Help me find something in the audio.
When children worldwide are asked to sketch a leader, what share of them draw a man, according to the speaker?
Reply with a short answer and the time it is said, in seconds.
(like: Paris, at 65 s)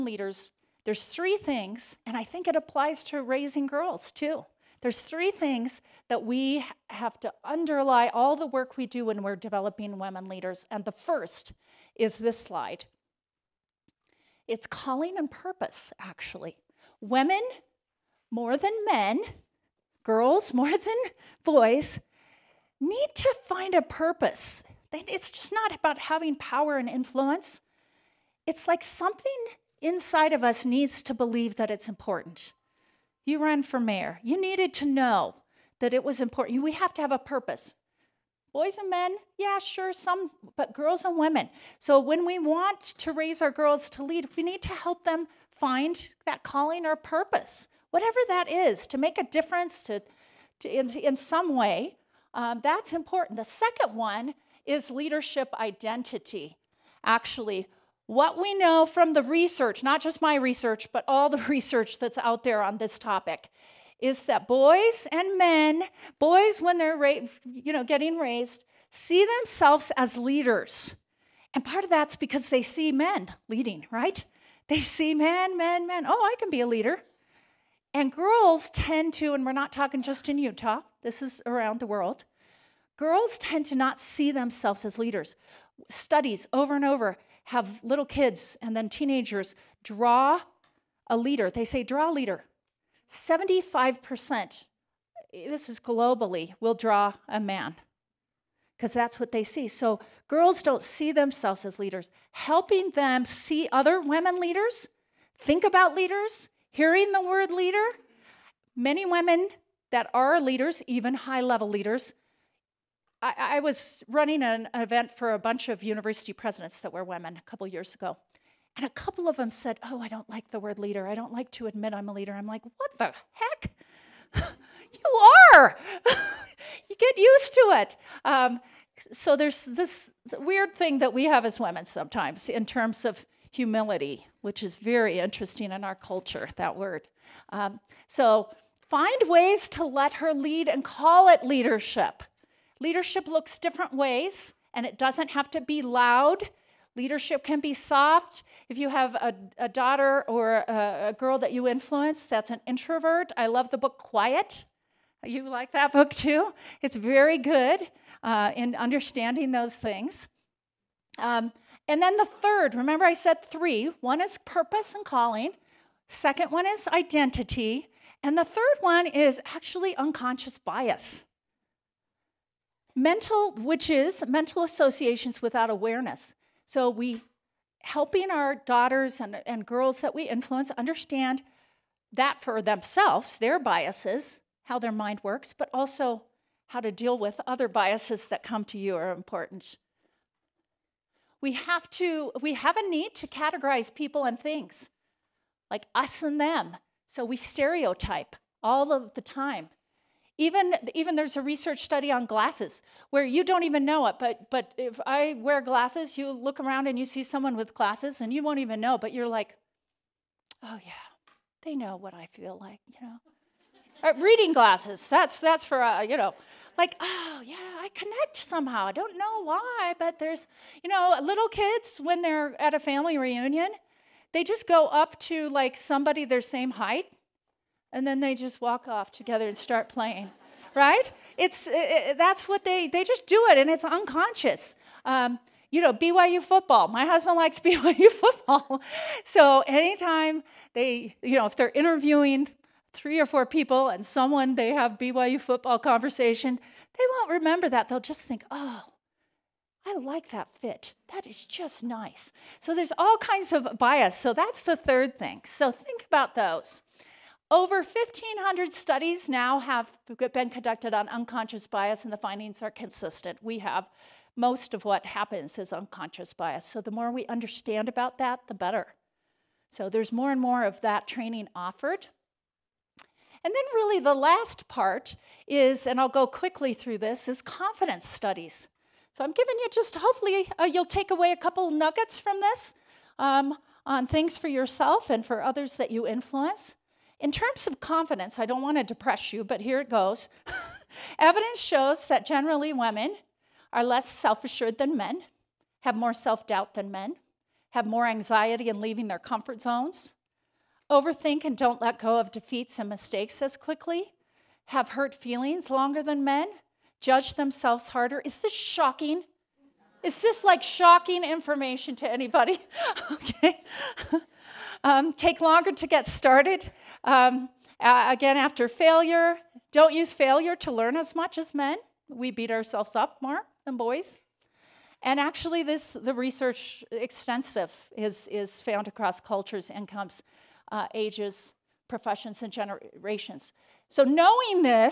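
75%, at 93 s.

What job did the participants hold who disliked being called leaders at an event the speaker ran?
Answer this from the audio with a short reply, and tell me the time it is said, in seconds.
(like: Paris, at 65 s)
University presidents, at 115 s.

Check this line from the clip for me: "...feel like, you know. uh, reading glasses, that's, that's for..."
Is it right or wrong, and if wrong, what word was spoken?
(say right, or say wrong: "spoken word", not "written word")
right.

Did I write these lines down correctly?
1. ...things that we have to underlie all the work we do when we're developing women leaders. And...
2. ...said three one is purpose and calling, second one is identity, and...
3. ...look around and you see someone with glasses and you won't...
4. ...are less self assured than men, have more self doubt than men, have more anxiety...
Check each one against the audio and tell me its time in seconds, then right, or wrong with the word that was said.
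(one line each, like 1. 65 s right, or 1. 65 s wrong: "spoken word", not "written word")
1. 5 s right
2. 163 s right
3. 206 s right
4. 293 s right.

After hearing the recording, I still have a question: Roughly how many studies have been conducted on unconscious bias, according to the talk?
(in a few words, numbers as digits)
1,500.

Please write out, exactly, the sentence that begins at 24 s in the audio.
It's just not about having power and influence.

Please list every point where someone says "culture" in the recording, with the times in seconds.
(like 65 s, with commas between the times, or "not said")
135 s, 329 s.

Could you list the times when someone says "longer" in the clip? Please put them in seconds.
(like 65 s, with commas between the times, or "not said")
305 s, 315 s.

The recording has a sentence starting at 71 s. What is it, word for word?
And part of that's because they see men leading, right?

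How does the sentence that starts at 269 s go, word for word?
So there's more and more of that training offered.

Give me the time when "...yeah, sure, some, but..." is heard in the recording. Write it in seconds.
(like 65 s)
39 s.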